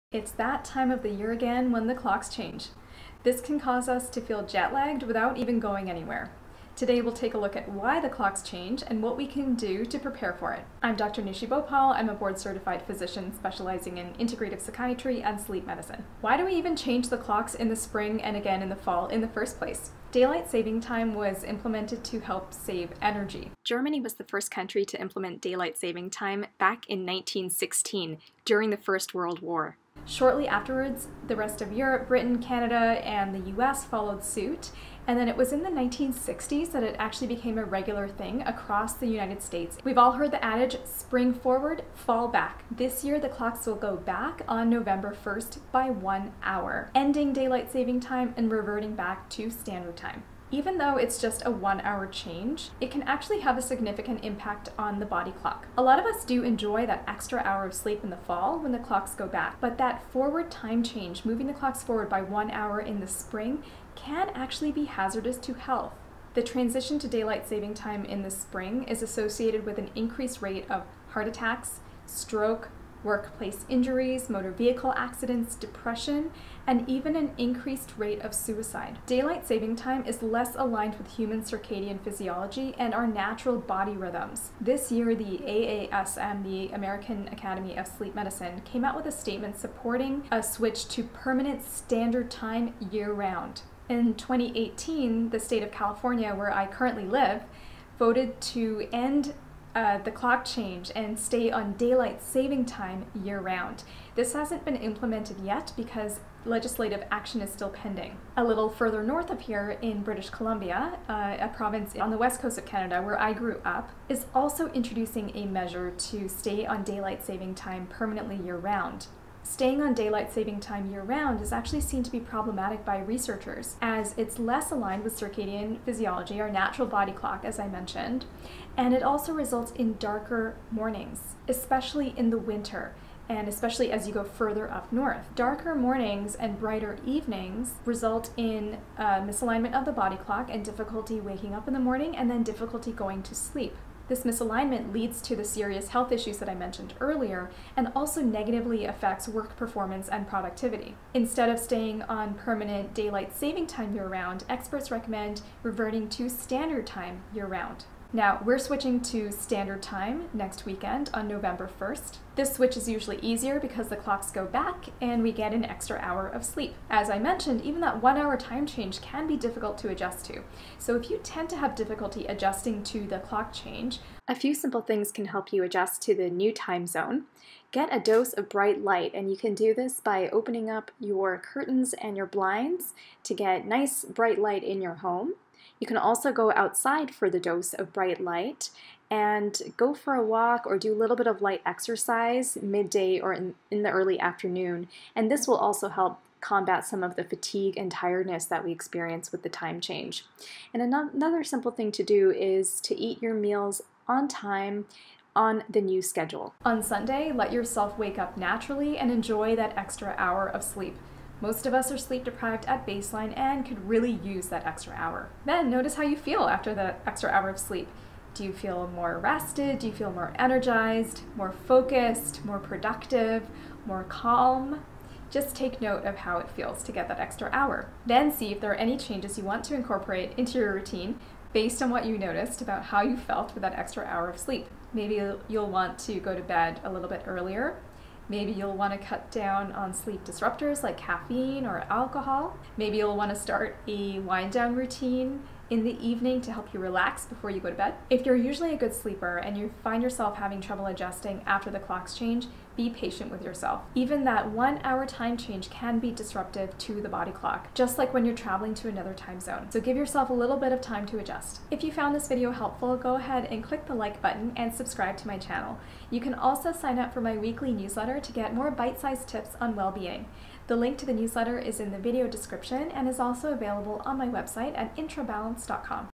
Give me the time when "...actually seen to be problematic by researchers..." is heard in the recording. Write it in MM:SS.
02:01.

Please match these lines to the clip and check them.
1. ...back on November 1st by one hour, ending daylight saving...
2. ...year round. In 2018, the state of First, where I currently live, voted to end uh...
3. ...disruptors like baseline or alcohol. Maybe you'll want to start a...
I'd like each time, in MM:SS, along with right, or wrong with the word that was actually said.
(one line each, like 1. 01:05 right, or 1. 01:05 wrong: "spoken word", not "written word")
1. 00:43 right
2. 01:32 wrong: "California", not "First"
3. 04:00 wrong: "caffeine", not "baseline".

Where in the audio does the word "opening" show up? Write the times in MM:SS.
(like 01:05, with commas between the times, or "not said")
03:00.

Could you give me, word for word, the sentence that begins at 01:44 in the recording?
This hasn't been implemented yet because legislative action is still pending.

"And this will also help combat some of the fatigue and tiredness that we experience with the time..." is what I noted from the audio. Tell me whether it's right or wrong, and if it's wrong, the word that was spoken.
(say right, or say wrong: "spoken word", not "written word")
right.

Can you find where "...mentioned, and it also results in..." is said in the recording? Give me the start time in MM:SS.
02:07.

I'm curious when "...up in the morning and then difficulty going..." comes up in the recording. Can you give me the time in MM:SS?
02:21.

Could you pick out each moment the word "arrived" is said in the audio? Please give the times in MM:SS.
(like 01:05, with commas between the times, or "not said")
not said.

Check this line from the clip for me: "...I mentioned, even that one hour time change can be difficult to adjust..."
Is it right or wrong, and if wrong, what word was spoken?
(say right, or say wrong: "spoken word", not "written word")
right.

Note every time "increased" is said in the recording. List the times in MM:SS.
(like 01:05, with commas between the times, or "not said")
01:09, 01:17.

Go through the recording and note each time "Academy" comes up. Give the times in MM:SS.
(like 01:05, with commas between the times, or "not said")
01:27.